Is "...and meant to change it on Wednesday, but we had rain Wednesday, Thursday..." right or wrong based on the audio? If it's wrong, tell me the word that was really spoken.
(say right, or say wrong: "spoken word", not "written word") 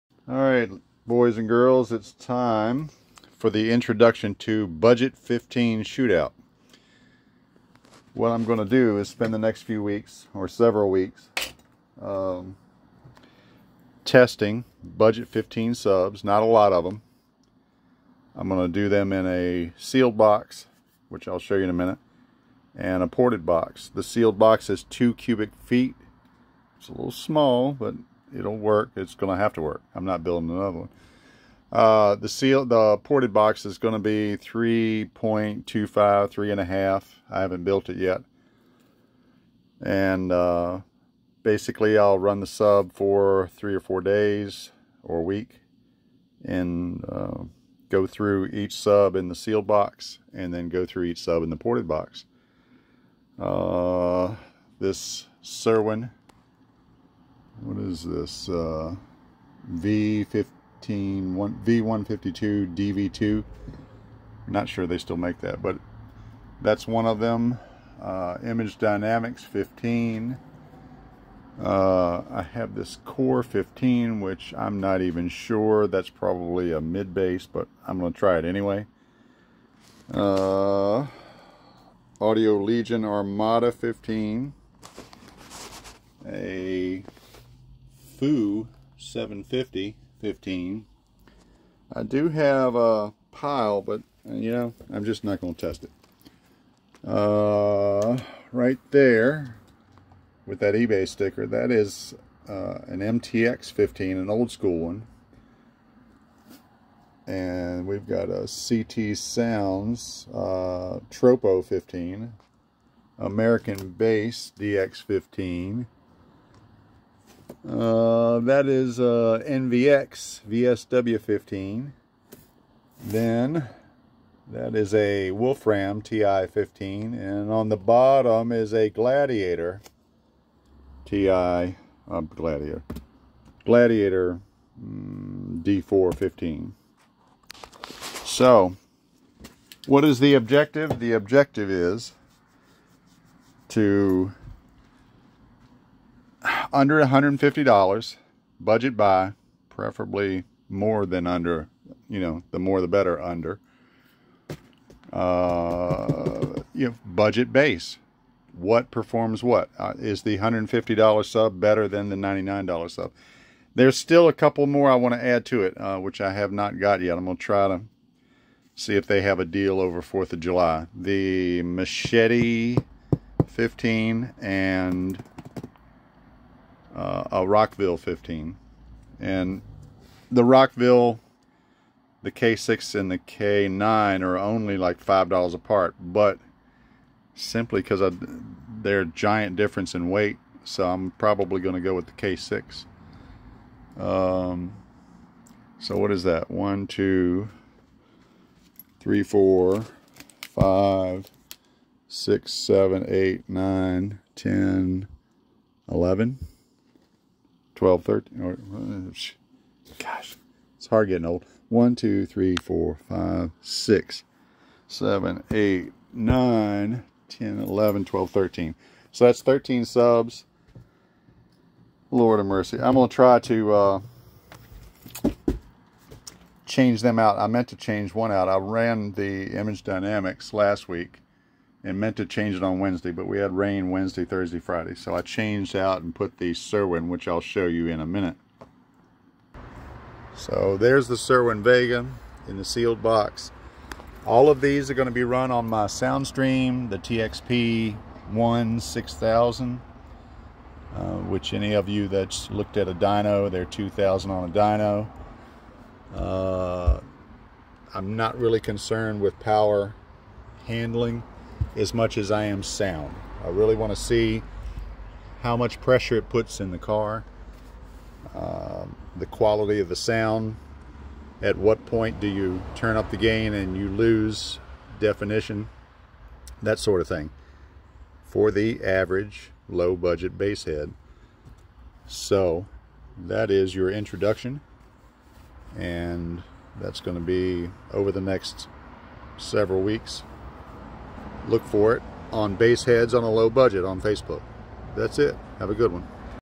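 right.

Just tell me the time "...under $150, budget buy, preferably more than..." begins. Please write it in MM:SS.
02:26.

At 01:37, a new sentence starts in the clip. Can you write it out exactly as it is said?
Uh, right there with that eBay sticker, that is uh, an MTX 15, an old school one.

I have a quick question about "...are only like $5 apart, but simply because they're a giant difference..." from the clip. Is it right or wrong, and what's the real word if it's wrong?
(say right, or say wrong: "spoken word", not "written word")
right.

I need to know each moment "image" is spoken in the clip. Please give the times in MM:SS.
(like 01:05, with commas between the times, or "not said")
01:08, 03:49.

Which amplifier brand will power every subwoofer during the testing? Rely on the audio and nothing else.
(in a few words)
Soundstream.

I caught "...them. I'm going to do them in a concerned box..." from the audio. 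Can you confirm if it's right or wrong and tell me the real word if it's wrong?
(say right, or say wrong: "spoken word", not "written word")
wrong: "sealed", not "concerned".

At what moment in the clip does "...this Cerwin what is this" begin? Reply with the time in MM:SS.
00:54.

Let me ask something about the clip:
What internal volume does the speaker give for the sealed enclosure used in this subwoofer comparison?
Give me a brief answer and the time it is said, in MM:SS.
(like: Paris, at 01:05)
2 cubic feet, at 00:24.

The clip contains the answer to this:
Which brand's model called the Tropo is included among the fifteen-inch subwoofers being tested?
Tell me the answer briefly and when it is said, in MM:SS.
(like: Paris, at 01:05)
CT Sounds, at 01:48.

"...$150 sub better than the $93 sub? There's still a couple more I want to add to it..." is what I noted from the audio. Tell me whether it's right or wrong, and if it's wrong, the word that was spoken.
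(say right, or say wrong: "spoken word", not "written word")
wrong: "99", not "93".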